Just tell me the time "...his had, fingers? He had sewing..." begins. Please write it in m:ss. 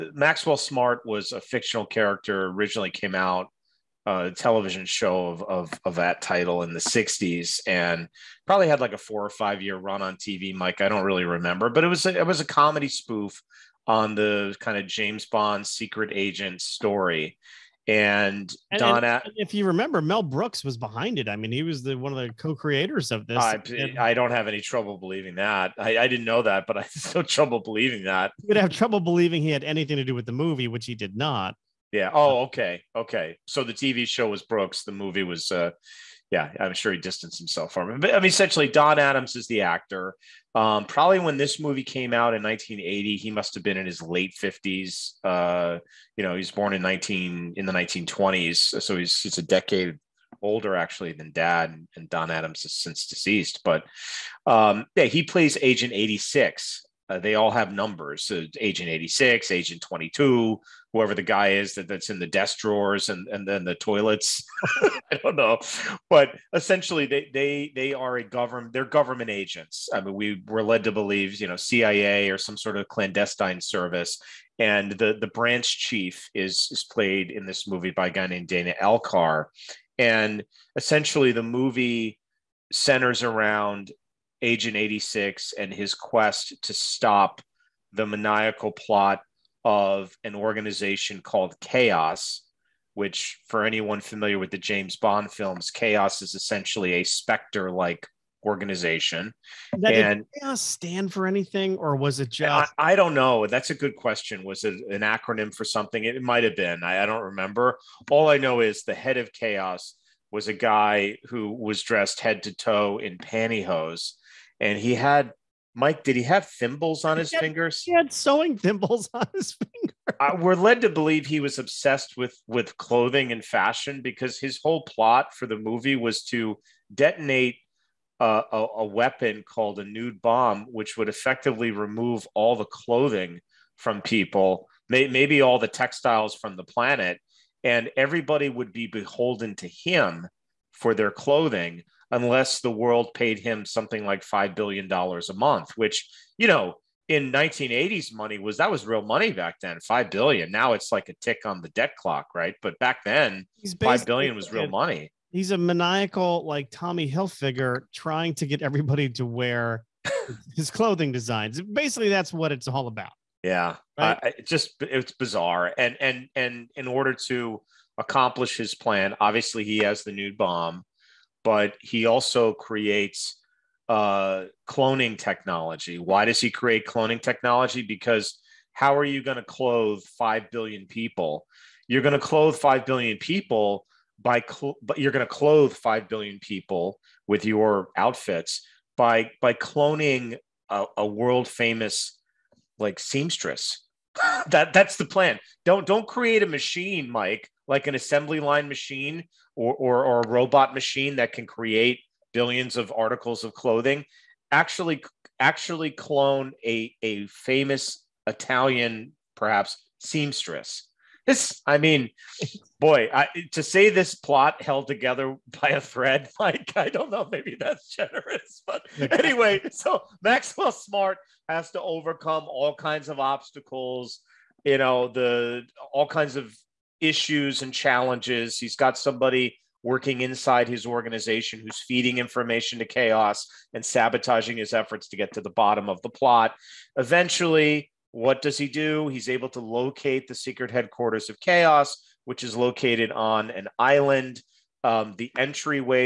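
1:57.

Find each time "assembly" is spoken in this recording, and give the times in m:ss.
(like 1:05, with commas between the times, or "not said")
3:17.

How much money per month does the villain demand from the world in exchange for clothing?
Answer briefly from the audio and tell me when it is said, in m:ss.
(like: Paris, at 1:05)
$5 billion, at 2:24.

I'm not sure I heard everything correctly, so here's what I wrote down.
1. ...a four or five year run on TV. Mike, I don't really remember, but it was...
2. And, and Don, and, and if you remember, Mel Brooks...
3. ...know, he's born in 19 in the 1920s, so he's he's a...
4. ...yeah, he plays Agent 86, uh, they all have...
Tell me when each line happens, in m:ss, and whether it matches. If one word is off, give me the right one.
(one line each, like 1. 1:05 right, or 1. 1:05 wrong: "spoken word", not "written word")
1. 0:08 right
2. 0:17 right
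3. 0:46 right
4. 0:54 right.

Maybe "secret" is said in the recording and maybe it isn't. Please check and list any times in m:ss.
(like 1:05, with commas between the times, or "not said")
0:15, 4:00.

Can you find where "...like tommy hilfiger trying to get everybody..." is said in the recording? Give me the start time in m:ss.
2:36.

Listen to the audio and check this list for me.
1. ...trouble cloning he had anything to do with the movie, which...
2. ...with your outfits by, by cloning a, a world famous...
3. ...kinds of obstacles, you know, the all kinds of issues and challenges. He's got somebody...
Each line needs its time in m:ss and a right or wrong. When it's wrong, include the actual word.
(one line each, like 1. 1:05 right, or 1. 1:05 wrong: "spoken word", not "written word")
1. 0:28 wrong: "believing", not "cloning"
2. 3:07 right
3. 3:42 right.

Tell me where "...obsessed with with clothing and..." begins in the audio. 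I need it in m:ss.
2:01.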